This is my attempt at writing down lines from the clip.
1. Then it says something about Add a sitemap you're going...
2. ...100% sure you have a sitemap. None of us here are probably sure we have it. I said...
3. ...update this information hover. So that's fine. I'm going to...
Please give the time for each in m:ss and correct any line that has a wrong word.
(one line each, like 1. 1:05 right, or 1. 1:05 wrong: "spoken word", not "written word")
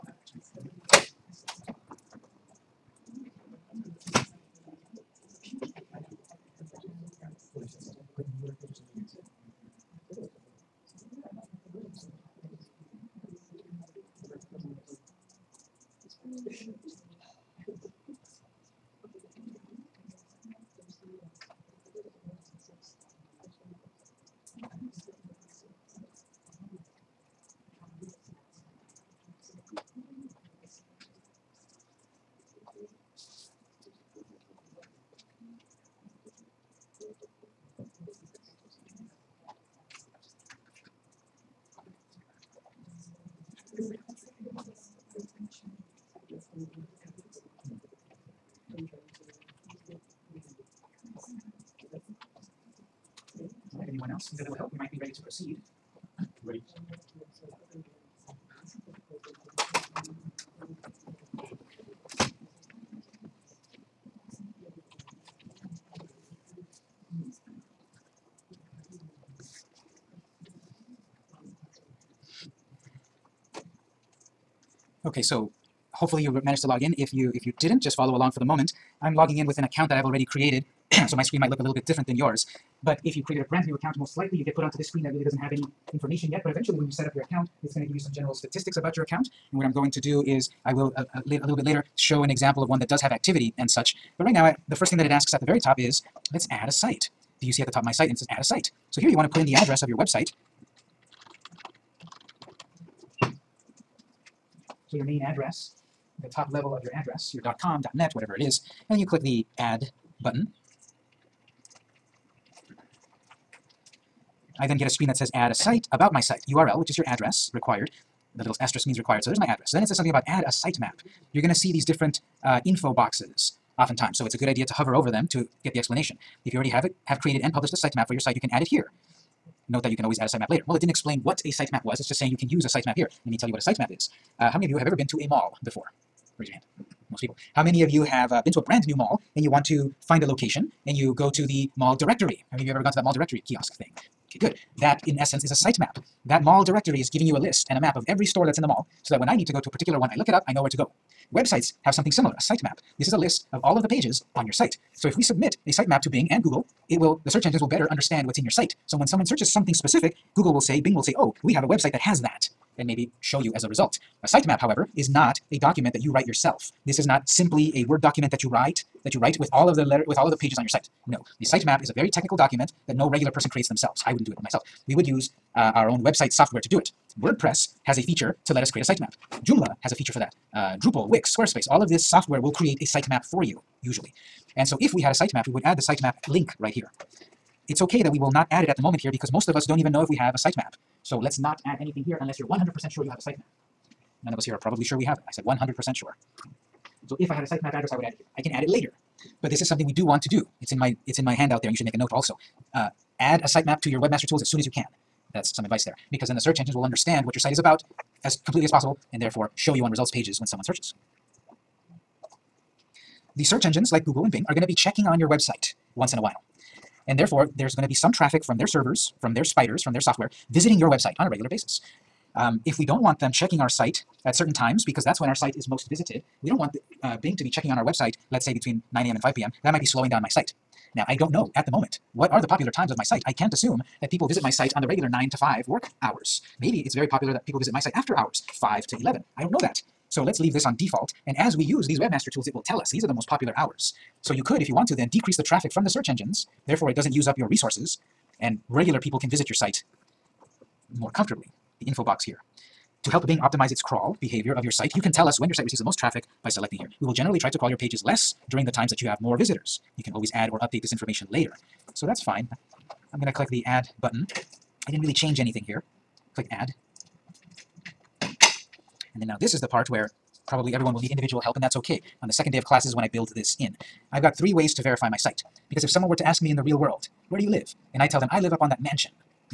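1. 1:59 right
2. 3:12 right
3. 4:20 wrong: "later", not "hover".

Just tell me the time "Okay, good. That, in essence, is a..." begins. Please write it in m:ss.
2:24.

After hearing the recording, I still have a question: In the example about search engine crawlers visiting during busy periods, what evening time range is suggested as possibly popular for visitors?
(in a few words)
5 to 11.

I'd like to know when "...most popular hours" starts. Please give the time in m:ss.
4:03.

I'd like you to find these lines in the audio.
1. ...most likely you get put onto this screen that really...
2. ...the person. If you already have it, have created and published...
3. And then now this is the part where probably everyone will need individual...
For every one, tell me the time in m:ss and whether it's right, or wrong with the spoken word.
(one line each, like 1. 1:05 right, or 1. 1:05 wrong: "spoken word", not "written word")
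1. 1:23 right
2. 2:05 wrong: "explanation", not "person"
3. 4:28 right.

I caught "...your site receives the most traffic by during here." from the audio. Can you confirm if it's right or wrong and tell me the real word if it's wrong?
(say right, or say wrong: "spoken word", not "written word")
wrong: "selecting", not "during".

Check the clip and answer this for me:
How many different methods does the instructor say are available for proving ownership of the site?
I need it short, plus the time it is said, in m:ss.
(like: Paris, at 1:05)
3, at 4:34.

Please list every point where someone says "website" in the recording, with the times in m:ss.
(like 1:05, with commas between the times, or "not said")
1:39, 2:31, 2:41, 2:56, 3:35, 3:40, 3:47.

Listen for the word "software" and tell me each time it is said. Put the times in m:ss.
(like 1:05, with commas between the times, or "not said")
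2:56, 3:02, 3:40.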